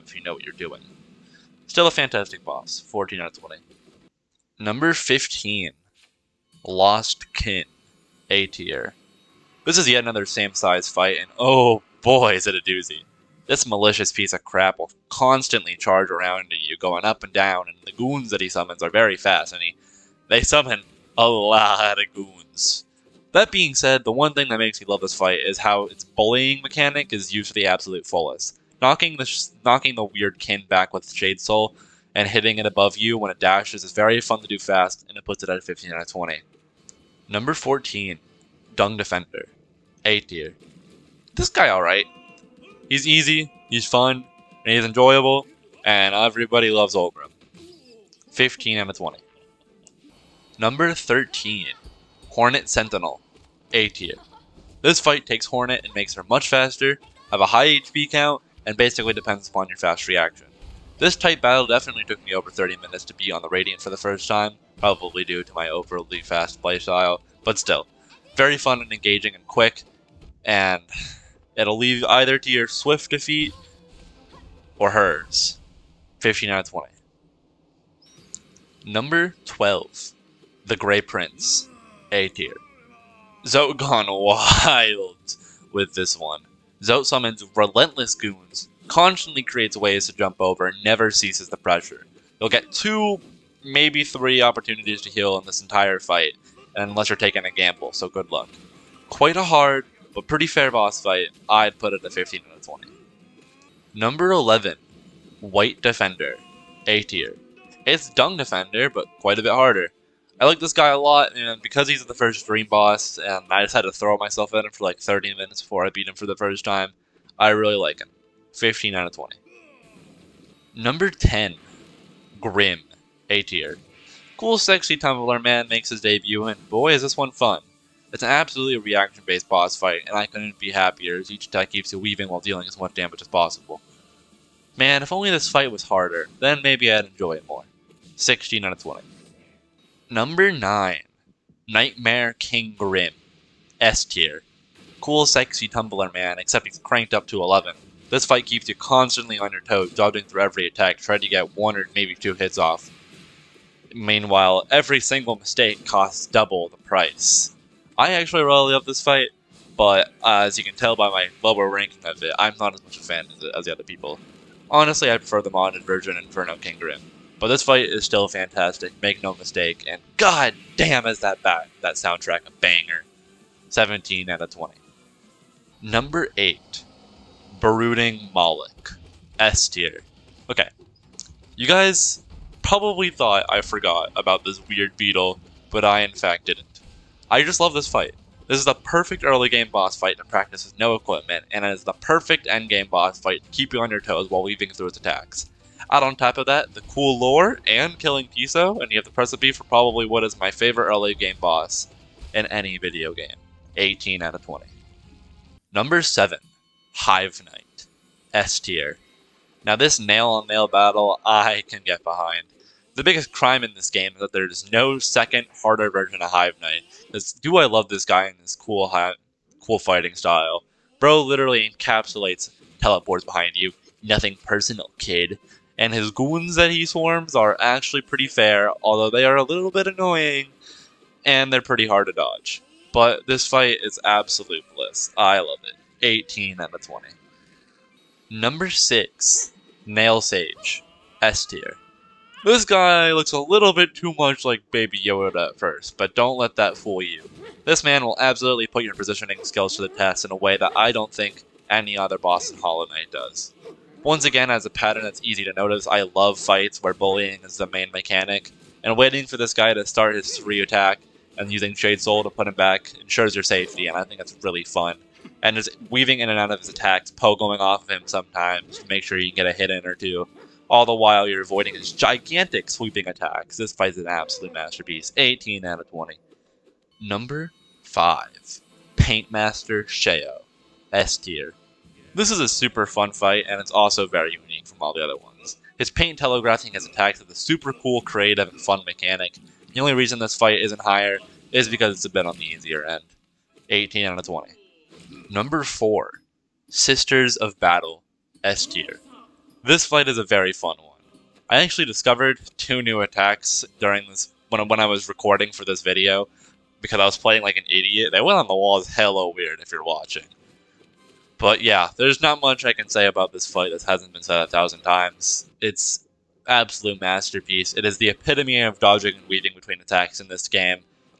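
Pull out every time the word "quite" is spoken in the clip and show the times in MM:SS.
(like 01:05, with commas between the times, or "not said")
01:39, 01:49.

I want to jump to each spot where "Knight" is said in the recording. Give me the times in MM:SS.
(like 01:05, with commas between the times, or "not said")
03:27, 03:36, 04:12.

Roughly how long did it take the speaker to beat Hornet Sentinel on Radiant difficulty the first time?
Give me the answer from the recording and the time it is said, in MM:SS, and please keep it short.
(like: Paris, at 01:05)
Over 30 minutes, at 01:02.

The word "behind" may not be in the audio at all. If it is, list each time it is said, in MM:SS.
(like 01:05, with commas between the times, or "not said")
03:32, 03:43.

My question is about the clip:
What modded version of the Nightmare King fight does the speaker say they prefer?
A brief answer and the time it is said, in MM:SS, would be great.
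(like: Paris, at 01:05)
Inferno Grimm, at 02:46.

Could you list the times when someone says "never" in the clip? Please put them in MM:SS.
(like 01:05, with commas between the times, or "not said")
01:30.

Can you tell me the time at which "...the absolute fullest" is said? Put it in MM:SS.
00:27.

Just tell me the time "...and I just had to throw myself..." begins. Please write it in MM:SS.
01:53.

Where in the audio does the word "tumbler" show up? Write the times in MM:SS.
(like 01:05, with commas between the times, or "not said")
02:04, 02:25.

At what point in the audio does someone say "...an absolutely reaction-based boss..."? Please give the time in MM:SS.
02:08.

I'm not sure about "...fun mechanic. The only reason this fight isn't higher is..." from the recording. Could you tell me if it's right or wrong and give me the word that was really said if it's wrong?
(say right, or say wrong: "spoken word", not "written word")
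right.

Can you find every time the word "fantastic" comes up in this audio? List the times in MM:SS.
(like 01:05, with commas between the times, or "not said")
00:01, 02:48.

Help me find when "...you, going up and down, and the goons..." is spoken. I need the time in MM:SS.
00:16.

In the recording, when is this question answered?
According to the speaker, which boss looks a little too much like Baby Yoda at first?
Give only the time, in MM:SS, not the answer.
03:59.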